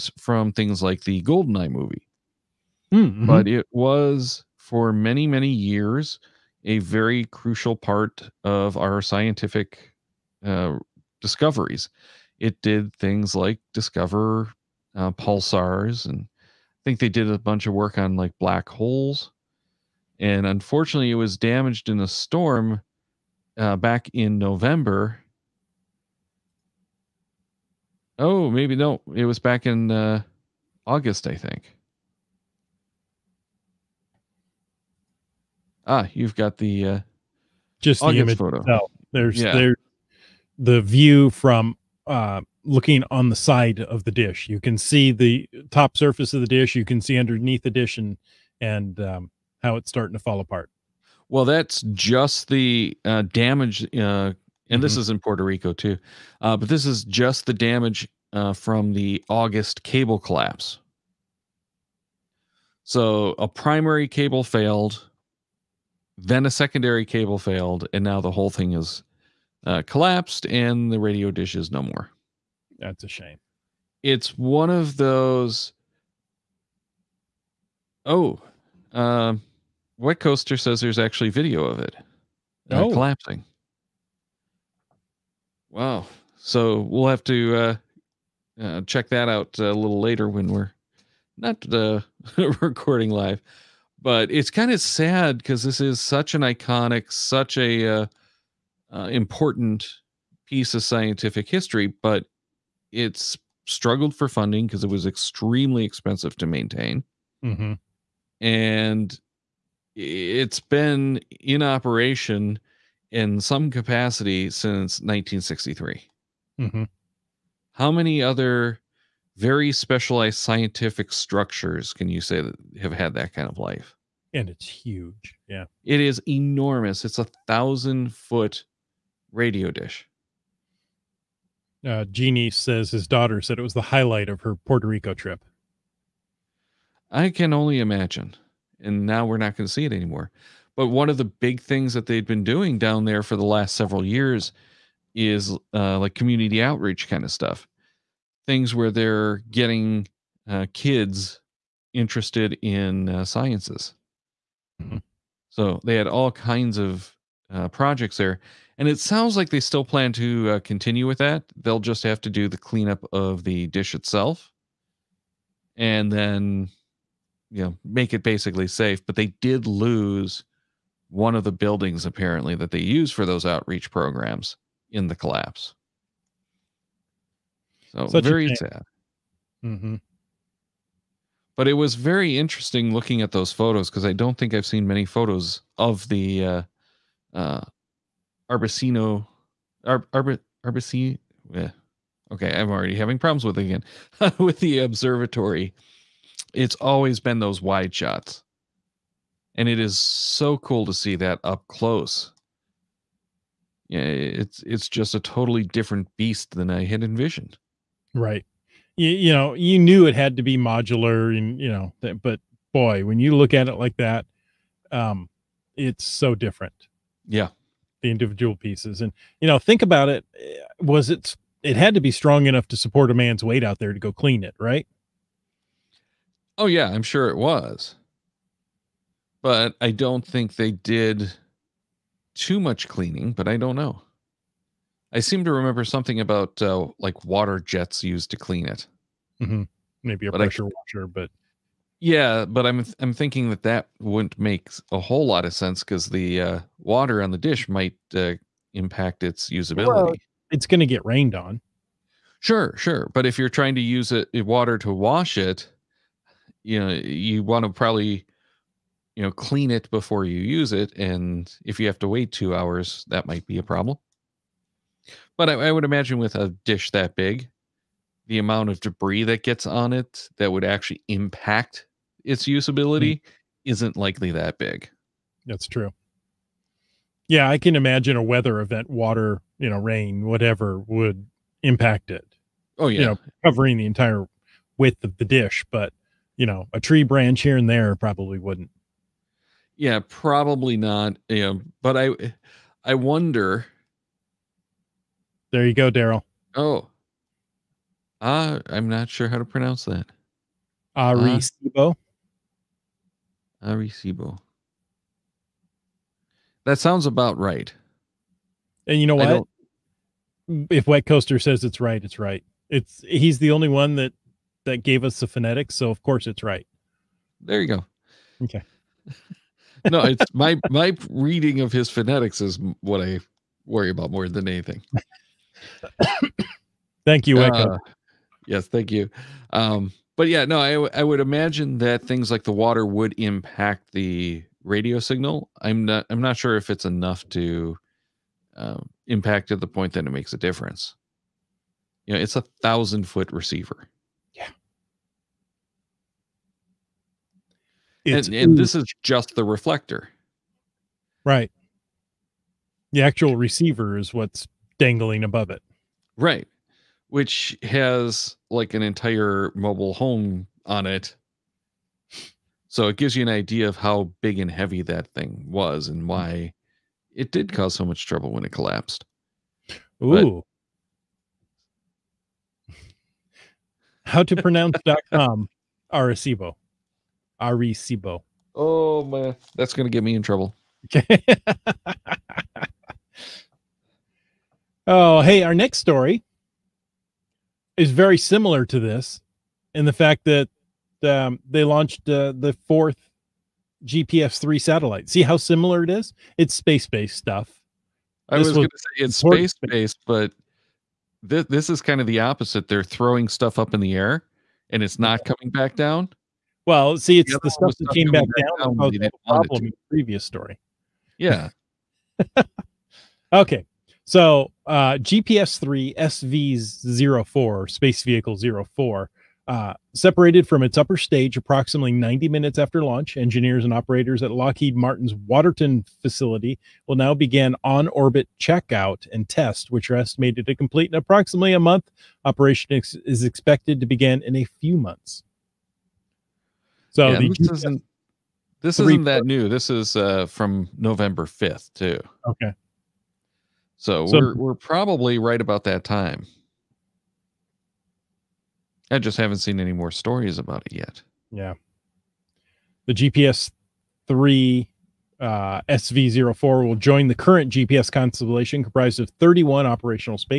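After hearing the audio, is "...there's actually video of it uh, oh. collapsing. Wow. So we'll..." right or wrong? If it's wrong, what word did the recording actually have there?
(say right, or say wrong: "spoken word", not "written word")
right.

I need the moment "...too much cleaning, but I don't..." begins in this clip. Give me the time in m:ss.
3:52.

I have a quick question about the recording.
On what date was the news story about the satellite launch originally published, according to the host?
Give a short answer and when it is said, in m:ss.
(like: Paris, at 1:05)
November 5, at 7:20.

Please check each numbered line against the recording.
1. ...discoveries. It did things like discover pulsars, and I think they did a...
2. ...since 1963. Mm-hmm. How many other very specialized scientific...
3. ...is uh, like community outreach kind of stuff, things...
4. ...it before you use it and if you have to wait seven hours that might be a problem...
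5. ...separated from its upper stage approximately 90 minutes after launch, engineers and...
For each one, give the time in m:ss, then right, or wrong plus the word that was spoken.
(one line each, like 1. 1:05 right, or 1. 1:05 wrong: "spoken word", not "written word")
1. 0:11 right
2. 1:54 right
3. 2:25 right
4. 4:19 wrong: "two", not "seven"
5. 6:59 right.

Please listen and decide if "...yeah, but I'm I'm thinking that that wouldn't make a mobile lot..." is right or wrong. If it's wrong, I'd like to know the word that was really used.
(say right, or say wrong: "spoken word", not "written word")
wrong: "whole", not "mobile".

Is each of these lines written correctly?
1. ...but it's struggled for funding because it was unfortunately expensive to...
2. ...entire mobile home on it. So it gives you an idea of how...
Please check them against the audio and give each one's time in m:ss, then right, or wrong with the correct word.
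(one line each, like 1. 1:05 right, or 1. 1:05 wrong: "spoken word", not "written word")
1. 1:41 wrong: "extremely", not "unfortunately"
2. 5:58 right.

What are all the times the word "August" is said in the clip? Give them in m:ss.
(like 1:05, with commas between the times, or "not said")
0:30, 0:38, 0:59.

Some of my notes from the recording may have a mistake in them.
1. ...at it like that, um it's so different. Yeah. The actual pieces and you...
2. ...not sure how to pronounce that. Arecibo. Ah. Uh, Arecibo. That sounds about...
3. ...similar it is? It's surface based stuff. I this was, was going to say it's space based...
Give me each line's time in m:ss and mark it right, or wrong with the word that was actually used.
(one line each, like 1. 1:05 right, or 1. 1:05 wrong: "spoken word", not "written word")
1. 3:33 wrong: "individual", not "actual"
2. 4:58 right
3. 6:35 wrong: "space", not "surface".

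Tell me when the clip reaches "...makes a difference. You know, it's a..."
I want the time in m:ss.
5:40.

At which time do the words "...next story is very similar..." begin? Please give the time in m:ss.
6:25.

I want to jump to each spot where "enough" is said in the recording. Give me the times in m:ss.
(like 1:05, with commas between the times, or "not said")
3:42, 5:36.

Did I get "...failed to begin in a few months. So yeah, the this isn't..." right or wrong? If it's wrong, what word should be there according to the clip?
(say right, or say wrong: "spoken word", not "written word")
wrong: "expected", not "failed".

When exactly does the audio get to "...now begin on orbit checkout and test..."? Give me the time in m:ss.
7:06.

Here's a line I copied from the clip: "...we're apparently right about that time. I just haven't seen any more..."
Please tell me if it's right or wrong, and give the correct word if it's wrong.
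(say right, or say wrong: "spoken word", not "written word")
wrong: "probably", not "apparently".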